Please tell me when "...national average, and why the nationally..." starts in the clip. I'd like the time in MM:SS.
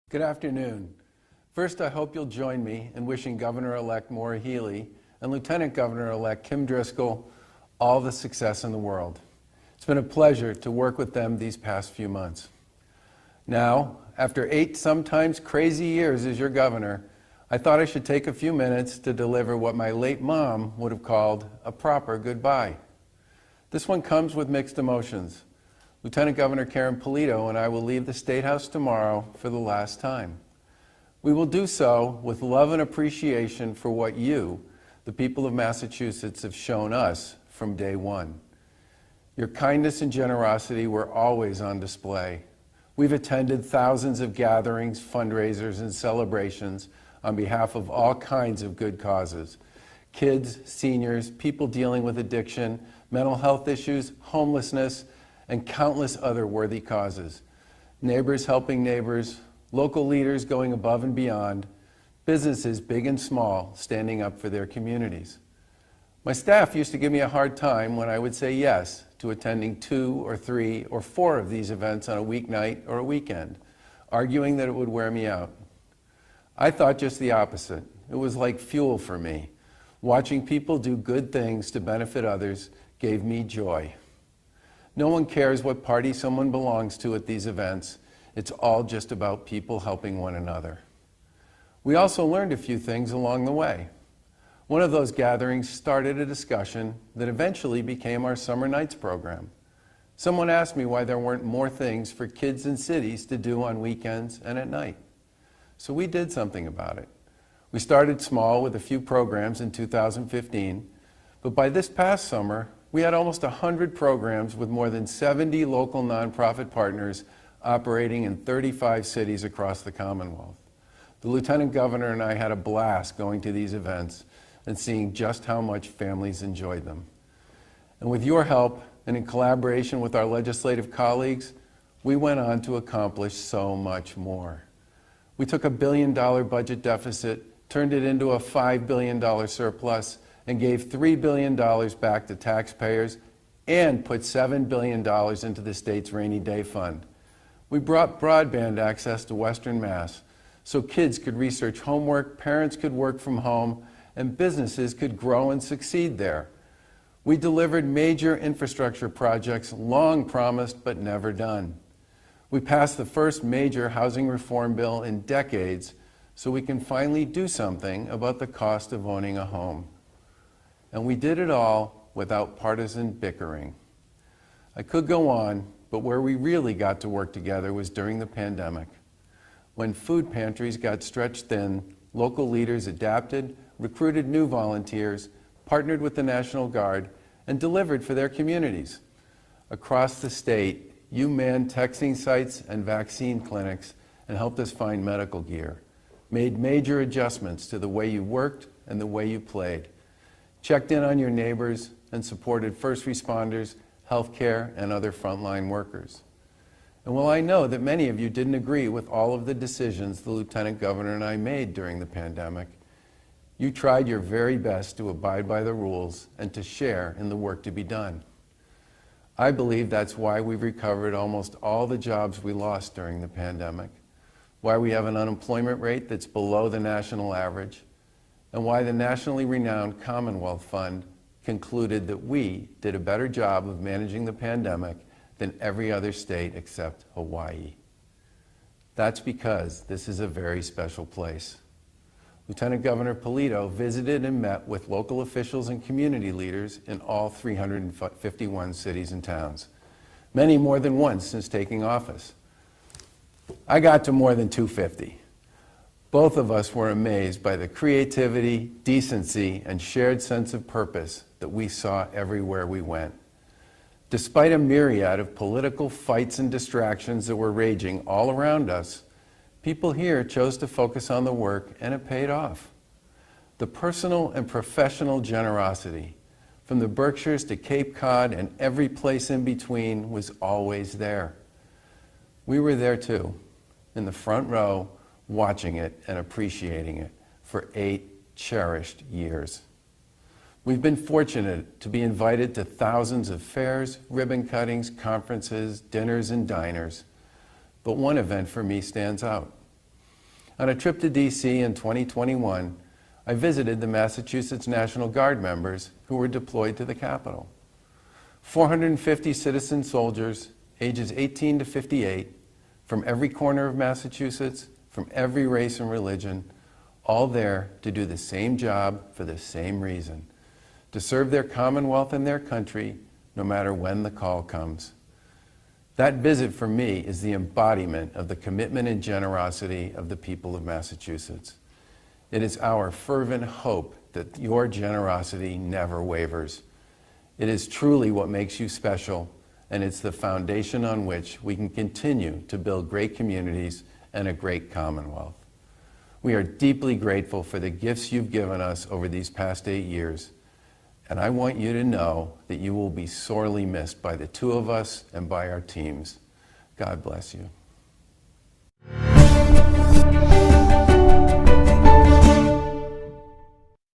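03:46.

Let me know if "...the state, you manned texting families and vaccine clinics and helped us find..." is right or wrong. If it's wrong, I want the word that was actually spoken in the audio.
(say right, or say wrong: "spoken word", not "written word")
wrong: "sites", not "families".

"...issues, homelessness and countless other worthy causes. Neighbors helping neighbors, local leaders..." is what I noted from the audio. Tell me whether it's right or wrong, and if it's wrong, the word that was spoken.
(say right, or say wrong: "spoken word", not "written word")
right.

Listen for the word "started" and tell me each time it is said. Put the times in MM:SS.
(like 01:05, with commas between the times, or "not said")
01:35, 01:47.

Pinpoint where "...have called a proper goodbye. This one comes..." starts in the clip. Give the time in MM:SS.
00:20.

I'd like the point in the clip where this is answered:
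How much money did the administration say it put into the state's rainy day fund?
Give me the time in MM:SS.
02:24.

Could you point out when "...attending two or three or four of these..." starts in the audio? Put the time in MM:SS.
01:09.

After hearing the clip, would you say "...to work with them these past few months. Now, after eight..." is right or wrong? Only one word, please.
right.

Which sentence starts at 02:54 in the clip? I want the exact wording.
I could go on, but where we really got to work together was during the pandemic.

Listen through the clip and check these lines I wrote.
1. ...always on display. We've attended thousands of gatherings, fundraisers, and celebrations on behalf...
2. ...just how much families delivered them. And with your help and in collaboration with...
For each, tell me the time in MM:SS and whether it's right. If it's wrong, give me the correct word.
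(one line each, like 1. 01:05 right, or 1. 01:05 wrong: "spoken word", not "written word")
1. 00:41 right
2. 02:05 wrong: "enjoyed", not "delivered".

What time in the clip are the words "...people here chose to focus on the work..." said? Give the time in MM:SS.
04:29.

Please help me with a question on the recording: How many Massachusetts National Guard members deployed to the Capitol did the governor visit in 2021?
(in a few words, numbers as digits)
450.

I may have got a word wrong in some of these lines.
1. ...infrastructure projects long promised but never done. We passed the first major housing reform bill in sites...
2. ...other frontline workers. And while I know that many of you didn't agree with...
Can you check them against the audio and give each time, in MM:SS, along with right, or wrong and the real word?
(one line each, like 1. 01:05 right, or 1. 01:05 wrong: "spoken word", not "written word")
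1. 02:38 wrong: "decades", not "sites"
2. 03:24 right.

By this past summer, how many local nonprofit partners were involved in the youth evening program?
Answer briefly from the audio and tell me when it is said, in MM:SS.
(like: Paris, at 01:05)
70, at 01:55.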